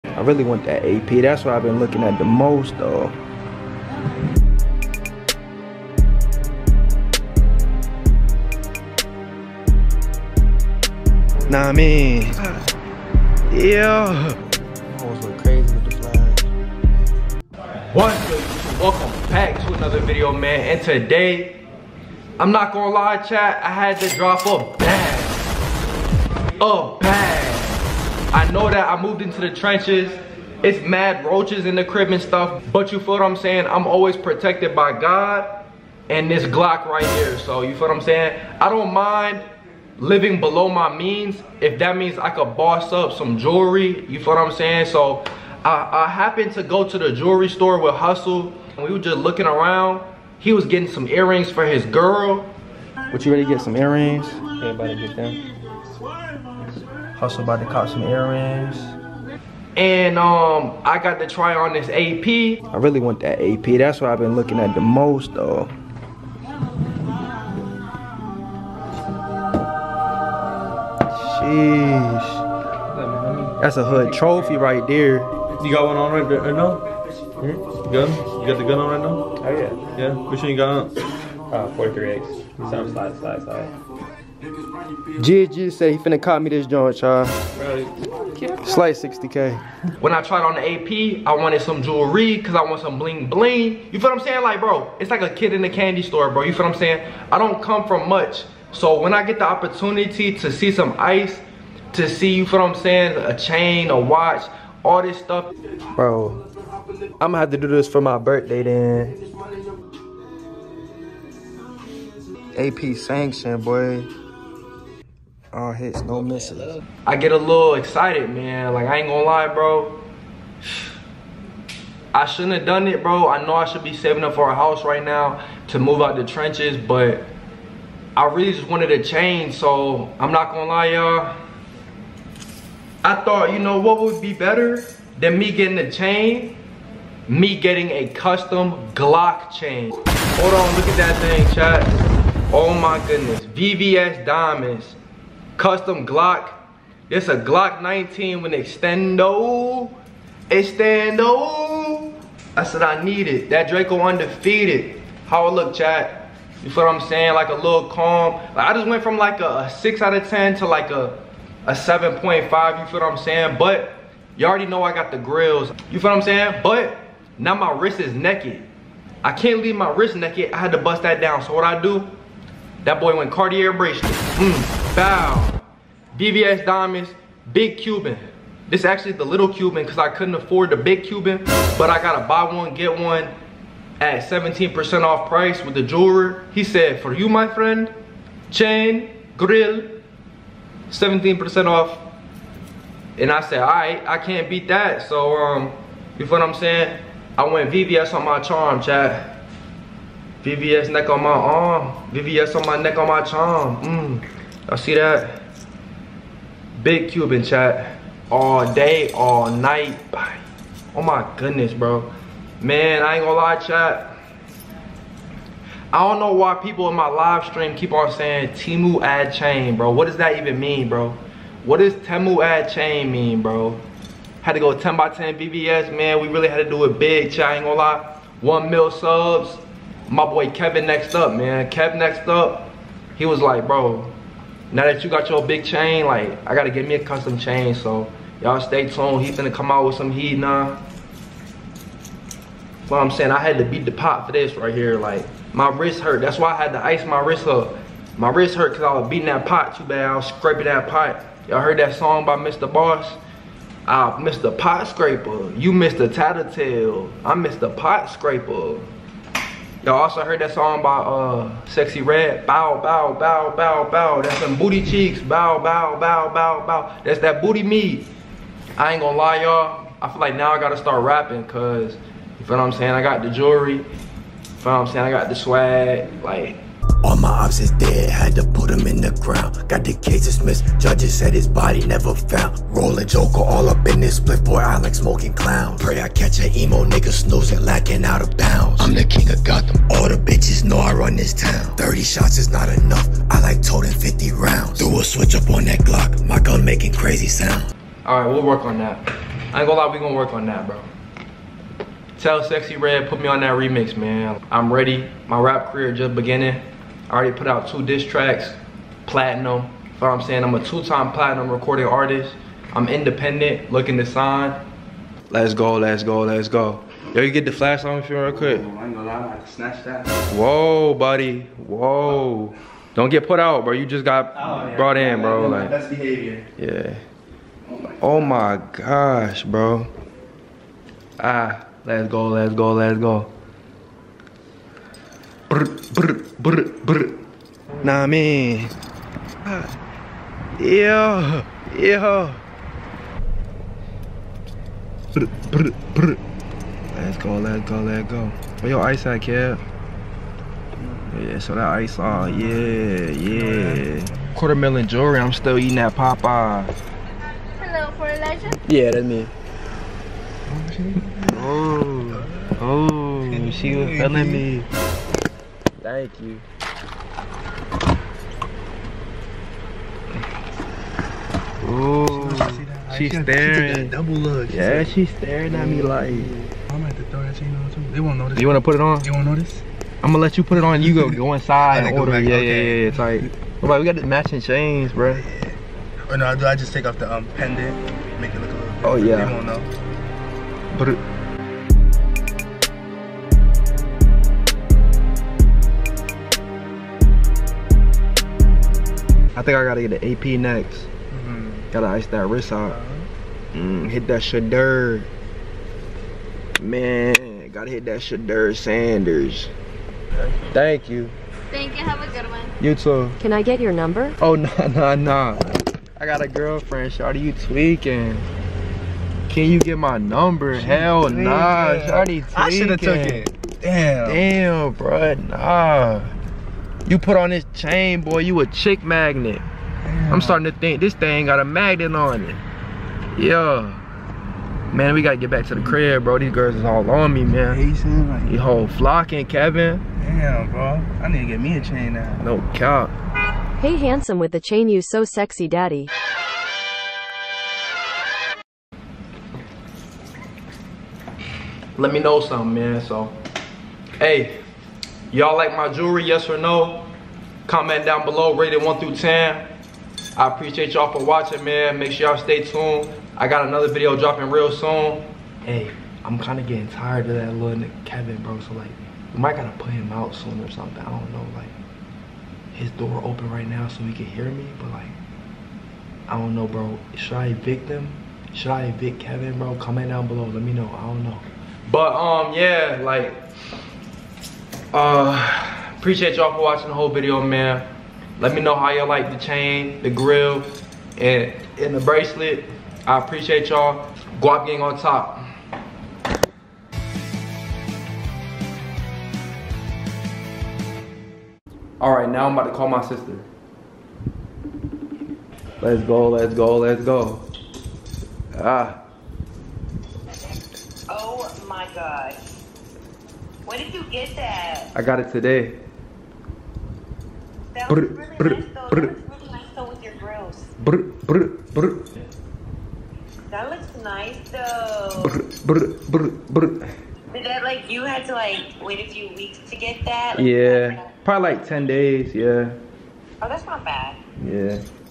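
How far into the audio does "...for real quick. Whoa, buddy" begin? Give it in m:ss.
5:18.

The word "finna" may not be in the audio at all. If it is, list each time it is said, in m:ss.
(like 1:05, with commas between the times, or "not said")
1:25, 3:59.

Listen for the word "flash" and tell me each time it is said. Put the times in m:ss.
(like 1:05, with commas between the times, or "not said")
0:17, 5:17.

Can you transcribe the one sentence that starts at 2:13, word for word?
I thought, you know, what would be better than me getting a chain?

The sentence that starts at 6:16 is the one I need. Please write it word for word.
I'm at the throw that chain on too.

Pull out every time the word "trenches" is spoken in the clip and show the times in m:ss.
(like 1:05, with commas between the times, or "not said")
0:29, 2:06.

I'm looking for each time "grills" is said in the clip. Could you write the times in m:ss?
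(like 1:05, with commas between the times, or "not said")
2:45, 3:09, 8:09, 8:39.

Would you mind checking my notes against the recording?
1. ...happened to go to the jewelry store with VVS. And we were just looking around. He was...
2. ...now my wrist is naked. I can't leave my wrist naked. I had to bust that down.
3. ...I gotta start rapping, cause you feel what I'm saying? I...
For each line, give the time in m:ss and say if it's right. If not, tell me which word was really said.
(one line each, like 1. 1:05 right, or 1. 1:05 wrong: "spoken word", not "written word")
1. 0:46 wrong: "Hustle", not "VVS"
2. 2:47 right
3. 4:30 right.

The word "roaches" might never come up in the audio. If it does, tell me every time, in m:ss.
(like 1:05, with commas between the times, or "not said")
0:31.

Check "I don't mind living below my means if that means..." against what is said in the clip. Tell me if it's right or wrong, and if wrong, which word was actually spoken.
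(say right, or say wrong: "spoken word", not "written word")
right.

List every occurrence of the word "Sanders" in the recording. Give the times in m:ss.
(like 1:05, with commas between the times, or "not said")
6:48.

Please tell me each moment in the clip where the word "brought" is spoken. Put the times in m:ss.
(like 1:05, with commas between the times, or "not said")
5:24.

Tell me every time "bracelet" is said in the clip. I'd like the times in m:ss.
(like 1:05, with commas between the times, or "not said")
2:53, 8:11.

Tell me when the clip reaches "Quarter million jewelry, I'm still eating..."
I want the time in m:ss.
5:54.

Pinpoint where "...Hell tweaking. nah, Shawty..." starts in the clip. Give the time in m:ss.
7:00.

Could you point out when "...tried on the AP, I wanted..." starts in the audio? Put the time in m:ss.
1:30.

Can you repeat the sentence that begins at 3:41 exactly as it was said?
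What does Temu ad chain mean, bro?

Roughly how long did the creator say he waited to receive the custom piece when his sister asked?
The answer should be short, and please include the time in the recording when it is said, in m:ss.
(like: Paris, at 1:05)
10 days, at 8:51.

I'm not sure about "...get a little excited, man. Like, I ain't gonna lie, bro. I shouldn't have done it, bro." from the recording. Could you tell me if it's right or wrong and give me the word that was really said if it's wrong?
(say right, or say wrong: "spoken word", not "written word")
right.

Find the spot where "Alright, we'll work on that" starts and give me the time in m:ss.
4:58.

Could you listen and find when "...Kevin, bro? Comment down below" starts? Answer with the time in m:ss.
7:59.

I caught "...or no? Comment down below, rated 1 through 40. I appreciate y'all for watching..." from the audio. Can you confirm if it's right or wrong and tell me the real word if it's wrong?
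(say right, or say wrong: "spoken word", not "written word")
wrong: "10", not "40".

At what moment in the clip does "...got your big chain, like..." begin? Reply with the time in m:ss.
3:55.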